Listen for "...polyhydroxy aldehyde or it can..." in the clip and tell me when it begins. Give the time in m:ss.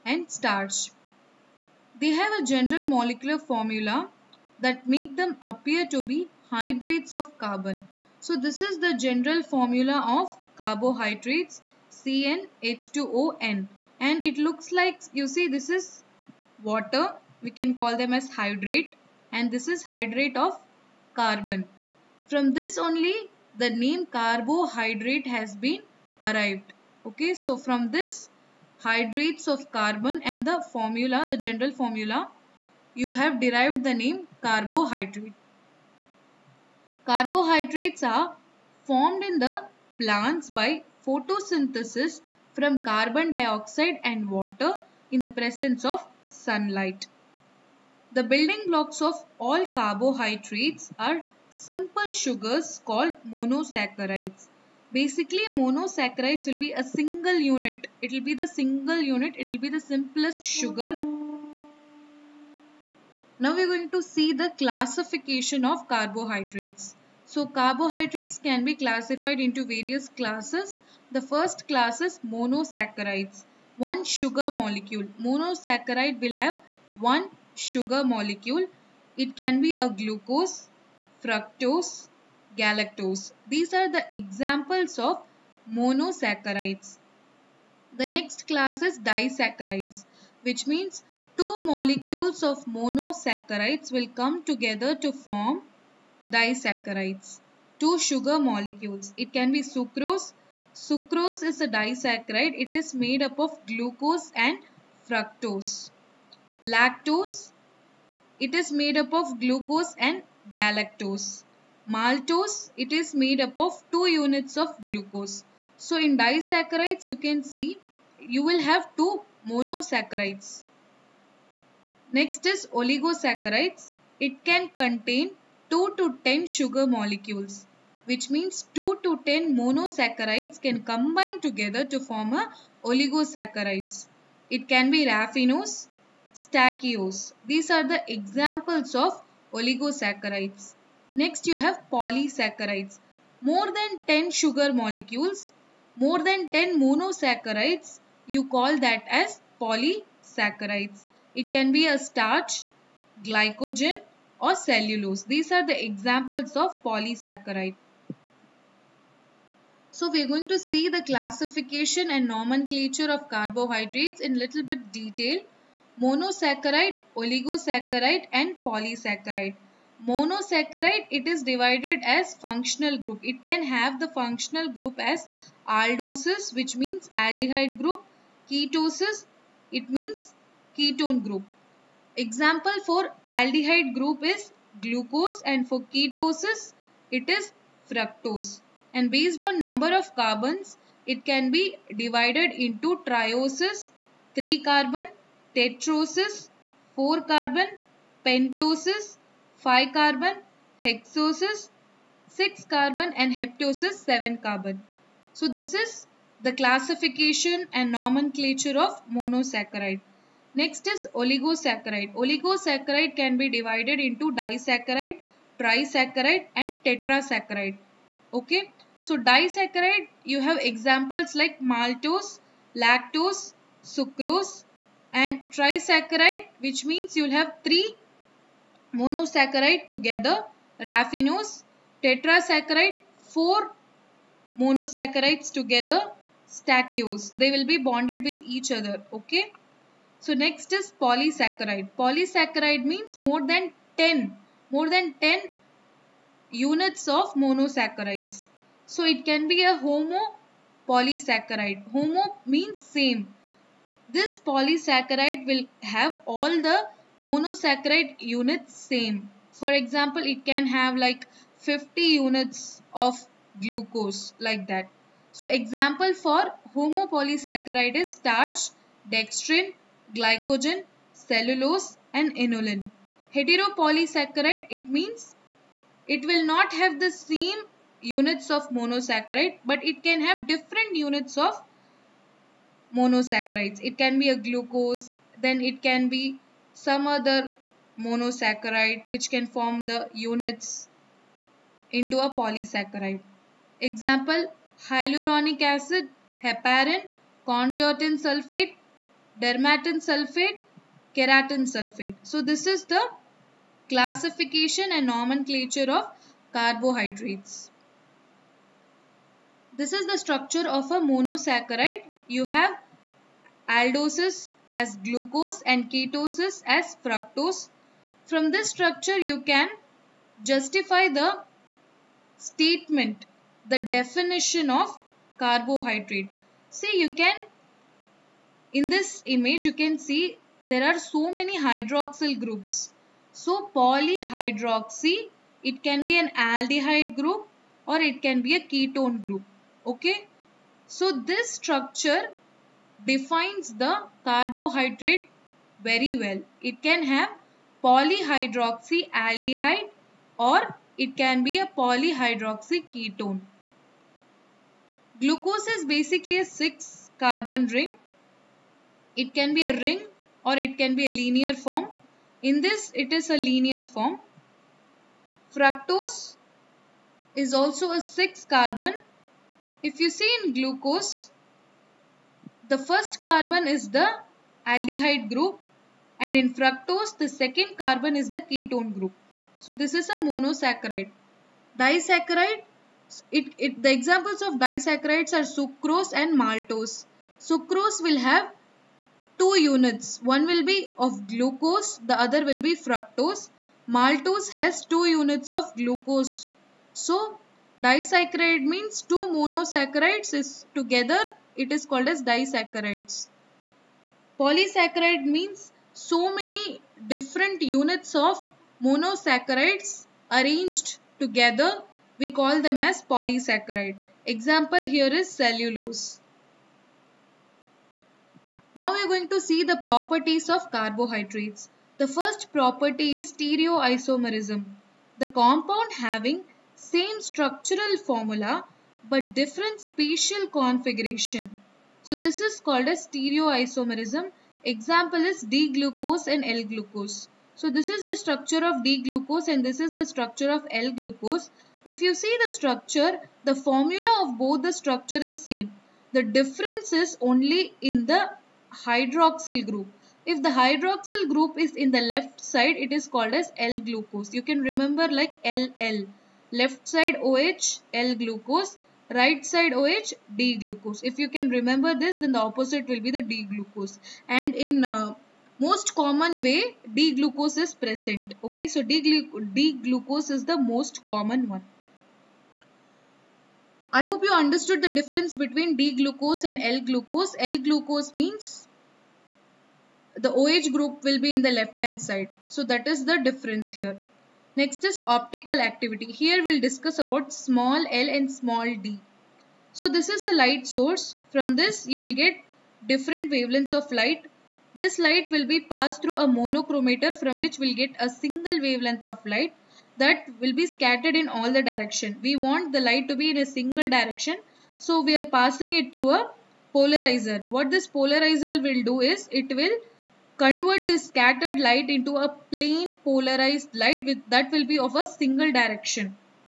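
5:47.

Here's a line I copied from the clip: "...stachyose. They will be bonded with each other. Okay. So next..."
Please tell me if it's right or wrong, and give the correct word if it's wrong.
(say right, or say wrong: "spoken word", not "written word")
right.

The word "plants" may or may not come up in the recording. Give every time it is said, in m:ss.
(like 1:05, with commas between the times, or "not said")
0:39.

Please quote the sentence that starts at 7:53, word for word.
I hope you understood the difference between D-glucose and L-glucose.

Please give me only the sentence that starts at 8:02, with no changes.
So that is the difference here.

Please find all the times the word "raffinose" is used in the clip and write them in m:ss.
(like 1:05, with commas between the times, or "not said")
2:15, 3:50.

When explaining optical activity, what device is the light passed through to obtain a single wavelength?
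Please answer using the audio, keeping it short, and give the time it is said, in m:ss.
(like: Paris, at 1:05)
monochromator, at 8:16.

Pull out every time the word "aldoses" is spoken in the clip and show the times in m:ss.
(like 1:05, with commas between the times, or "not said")
2:55, 5:13.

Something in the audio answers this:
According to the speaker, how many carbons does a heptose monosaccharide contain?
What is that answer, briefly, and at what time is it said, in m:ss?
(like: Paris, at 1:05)
7, at 3:24.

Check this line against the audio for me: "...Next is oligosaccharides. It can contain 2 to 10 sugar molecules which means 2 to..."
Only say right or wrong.
right.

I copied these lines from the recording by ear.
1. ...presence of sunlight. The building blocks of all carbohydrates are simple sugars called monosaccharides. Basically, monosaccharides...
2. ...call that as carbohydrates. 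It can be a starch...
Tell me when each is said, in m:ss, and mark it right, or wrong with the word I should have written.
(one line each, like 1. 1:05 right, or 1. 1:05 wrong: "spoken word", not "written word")
1. 0:45 right
2. 2:28 wrong: "polysaccharides", not "carbohydrates".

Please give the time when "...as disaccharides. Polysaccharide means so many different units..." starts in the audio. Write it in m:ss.
6:42.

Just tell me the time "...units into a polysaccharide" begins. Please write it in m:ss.
4:50.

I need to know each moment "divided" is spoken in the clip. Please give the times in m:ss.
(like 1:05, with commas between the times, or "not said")
2:51, 3:12, 3:33.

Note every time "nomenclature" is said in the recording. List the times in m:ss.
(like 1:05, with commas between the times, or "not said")
2:42, 3:27, 5:05.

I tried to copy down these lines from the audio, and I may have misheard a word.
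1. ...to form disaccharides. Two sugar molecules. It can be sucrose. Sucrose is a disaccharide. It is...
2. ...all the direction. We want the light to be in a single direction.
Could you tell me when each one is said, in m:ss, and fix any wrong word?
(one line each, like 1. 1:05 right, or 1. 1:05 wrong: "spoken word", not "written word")
1. 1:35 right
2. 8:21 right.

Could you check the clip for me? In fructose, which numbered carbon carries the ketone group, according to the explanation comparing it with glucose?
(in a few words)
second.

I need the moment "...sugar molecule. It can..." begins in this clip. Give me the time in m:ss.
1:17.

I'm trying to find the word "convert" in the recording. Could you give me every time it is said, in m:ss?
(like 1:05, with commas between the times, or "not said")
8:30.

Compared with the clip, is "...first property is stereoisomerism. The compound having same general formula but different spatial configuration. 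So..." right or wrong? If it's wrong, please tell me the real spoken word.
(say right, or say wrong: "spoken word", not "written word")
wrong: "structural", not "general".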